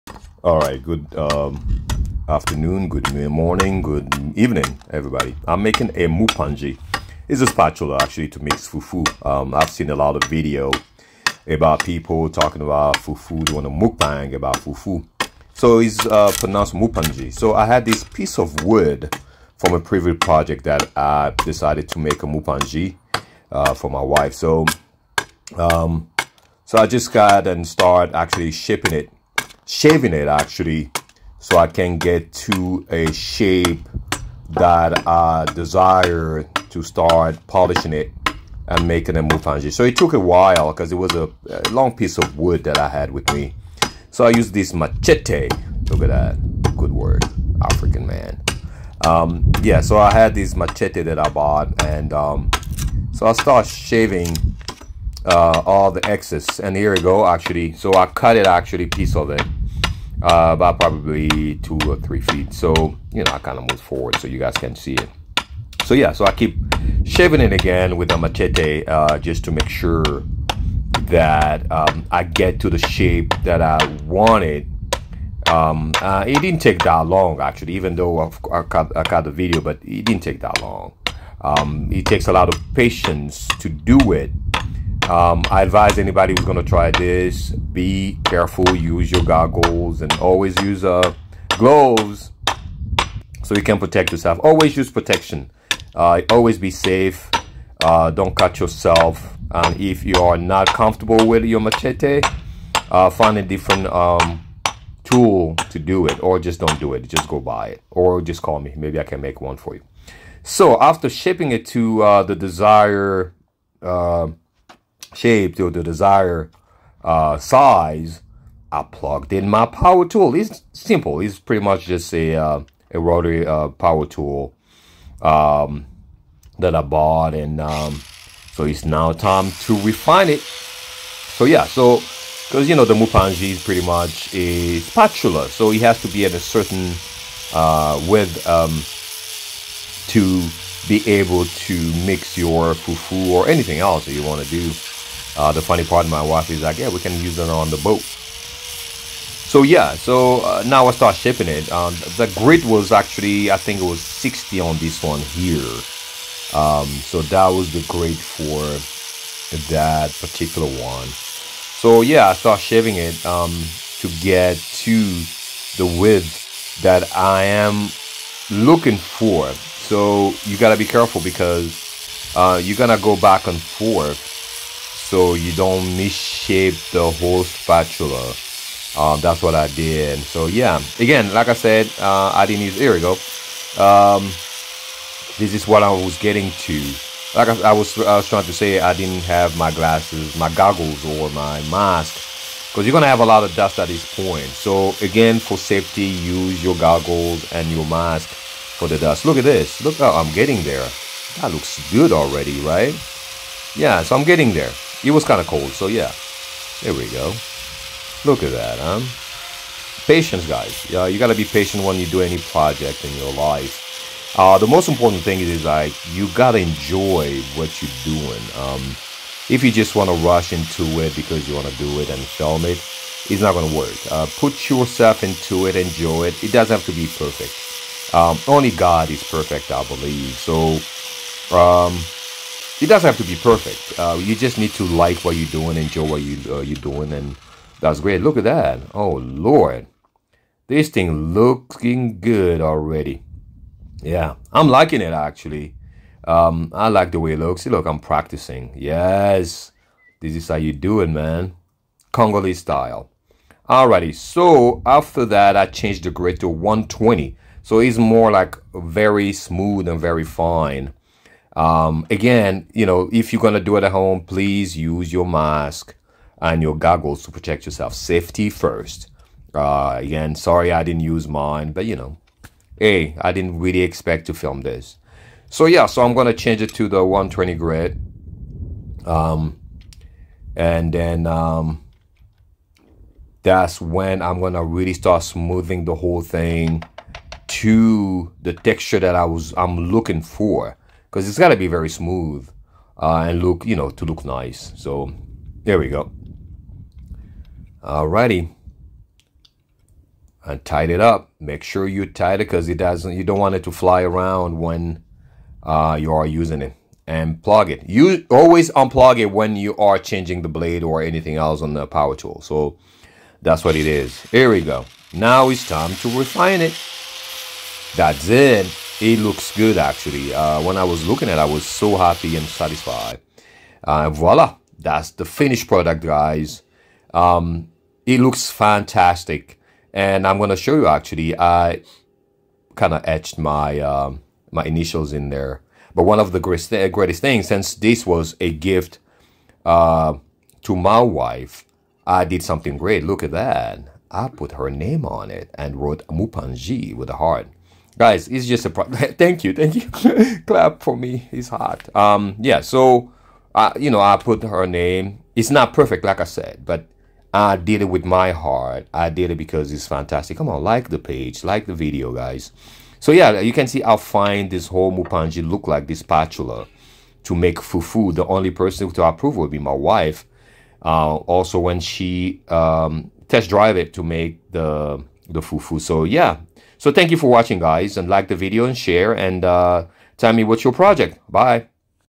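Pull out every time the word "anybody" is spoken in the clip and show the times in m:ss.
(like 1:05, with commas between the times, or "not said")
1:25.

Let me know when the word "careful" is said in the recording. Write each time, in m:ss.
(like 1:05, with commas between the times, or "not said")
1:28, 2:50.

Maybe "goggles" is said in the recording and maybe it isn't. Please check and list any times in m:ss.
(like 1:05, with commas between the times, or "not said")
1:29, 3:10, 3:16, 4:26.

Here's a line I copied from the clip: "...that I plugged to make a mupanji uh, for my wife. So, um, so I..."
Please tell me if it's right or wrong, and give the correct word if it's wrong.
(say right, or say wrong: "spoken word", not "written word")
wrong: "decided", not "plugged".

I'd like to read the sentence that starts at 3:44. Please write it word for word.
Uh, put yourself into it, enjoy it.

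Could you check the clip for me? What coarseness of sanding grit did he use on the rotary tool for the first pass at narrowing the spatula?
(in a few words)
60.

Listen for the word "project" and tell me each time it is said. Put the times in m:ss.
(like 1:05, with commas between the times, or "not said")
0:20, 3:32, 6:20.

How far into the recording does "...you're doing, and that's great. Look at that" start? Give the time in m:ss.
3:56.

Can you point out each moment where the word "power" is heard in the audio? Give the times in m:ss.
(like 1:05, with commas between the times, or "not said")
1:59, 2:03, 5:11.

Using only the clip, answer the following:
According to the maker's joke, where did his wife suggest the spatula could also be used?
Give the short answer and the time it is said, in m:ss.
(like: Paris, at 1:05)
on the boat, at 2:26.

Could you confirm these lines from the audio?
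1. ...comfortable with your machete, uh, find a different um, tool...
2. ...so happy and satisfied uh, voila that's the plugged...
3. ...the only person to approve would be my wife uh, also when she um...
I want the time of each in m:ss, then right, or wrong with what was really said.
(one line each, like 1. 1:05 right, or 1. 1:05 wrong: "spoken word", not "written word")
1. 1:40 right
2. 5:21 wrong: "finished", not "plugged"
3. 6:08 right.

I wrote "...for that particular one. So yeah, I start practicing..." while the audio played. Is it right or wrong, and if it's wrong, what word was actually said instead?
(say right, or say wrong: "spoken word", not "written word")
wrong: "shaving", not "practicing".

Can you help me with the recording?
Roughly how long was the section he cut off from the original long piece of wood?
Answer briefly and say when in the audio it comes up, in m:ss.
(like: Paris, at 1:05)
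2 or 3 feet, at 1:01.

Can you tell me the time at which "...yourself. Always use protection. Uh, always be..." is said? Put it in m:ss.
1:34.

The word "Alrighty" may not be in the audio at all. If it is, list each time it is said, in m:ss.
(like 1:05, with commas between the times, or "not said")
4:13, 4:57.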